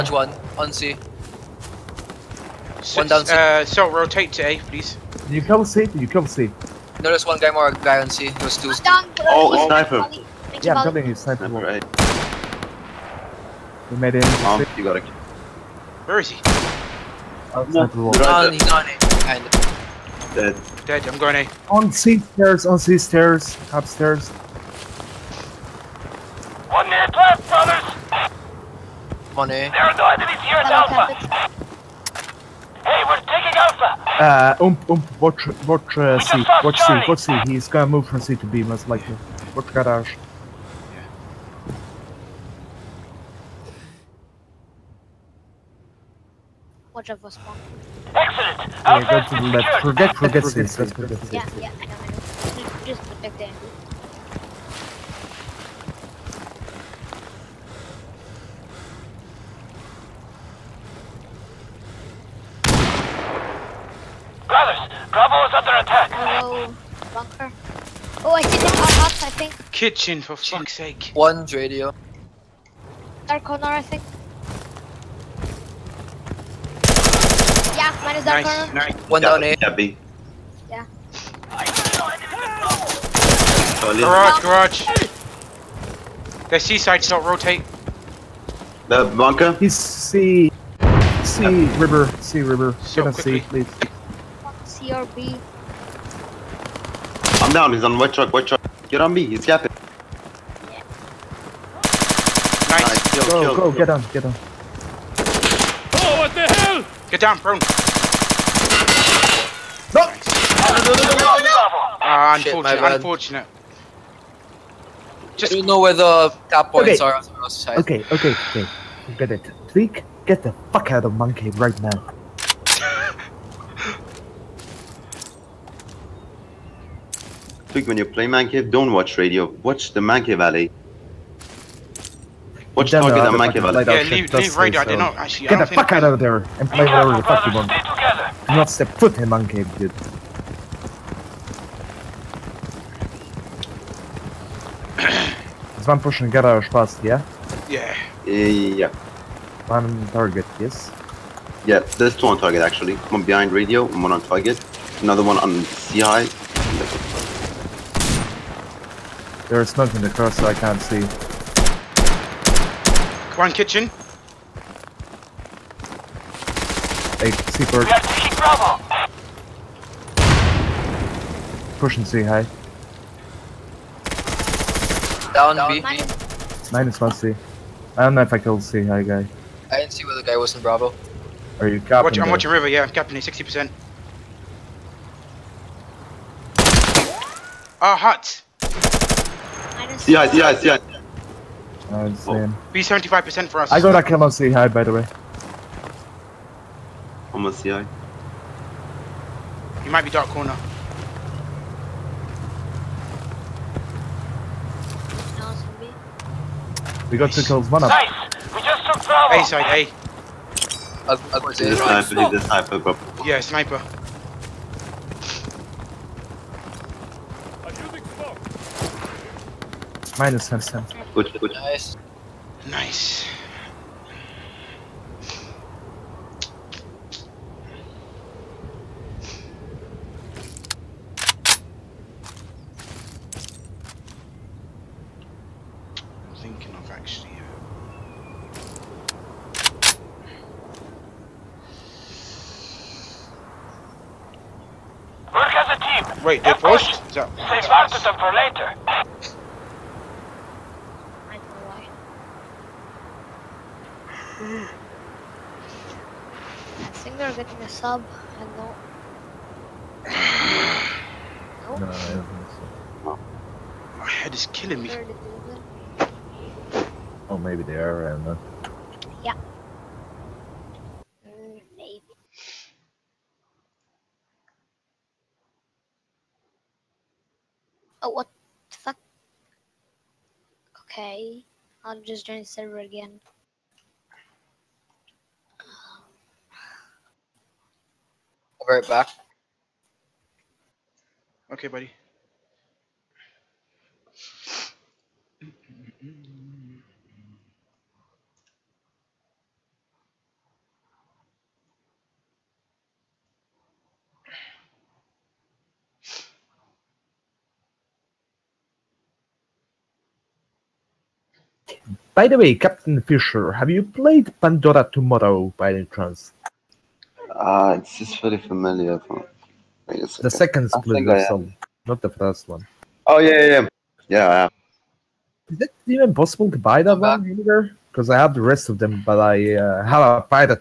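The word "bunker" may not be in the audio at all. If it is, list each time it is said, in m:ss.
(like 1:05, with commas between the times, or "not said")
1:07, 1:29.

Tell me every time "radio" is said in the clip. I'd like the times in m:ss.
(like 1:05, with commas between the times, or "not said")
1:11, 2:09, 2:14, 2:33.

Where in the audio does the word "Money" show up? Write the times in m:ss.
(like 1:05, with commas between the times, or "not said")
0:29.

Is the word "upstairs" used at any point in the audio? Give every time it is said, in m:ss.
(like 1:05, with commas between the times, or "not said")
0:23.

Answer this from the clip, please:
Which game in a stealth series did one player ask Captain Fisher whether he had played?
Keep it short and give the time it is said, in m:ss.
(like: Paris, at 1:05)
Pandora Tomorrow, at 5:14.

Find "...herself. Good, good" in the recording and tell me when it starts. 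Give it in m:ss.
3:40.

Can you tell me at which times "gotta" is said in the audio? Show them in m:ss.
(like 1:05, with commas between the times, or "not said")
0:14.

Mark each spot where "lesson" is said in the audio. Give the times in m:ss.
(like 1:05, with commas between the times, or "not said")
not said.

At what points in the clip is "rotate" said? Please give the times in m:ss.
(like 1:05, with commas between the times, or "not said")
0:03, 1:27.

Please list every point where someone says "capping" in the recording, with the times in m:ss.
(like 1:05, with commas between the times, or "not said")
1:39, 3:01.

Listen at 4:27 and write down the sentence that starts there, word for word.
Oh, maybe they are around then.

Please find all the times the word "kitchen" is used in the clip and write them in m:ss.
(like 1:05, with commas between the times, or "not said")
1:09, 2:43.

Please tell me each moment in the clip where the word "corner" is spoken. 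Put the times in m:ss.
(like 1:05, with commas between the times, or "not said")
1:13, 1:18, 3:20.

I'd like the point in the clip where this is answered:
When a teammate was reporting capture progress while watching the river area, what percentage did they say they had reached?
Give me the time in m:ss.
3:02.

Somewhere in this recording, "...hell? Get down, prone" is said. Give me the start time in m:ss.
1:46.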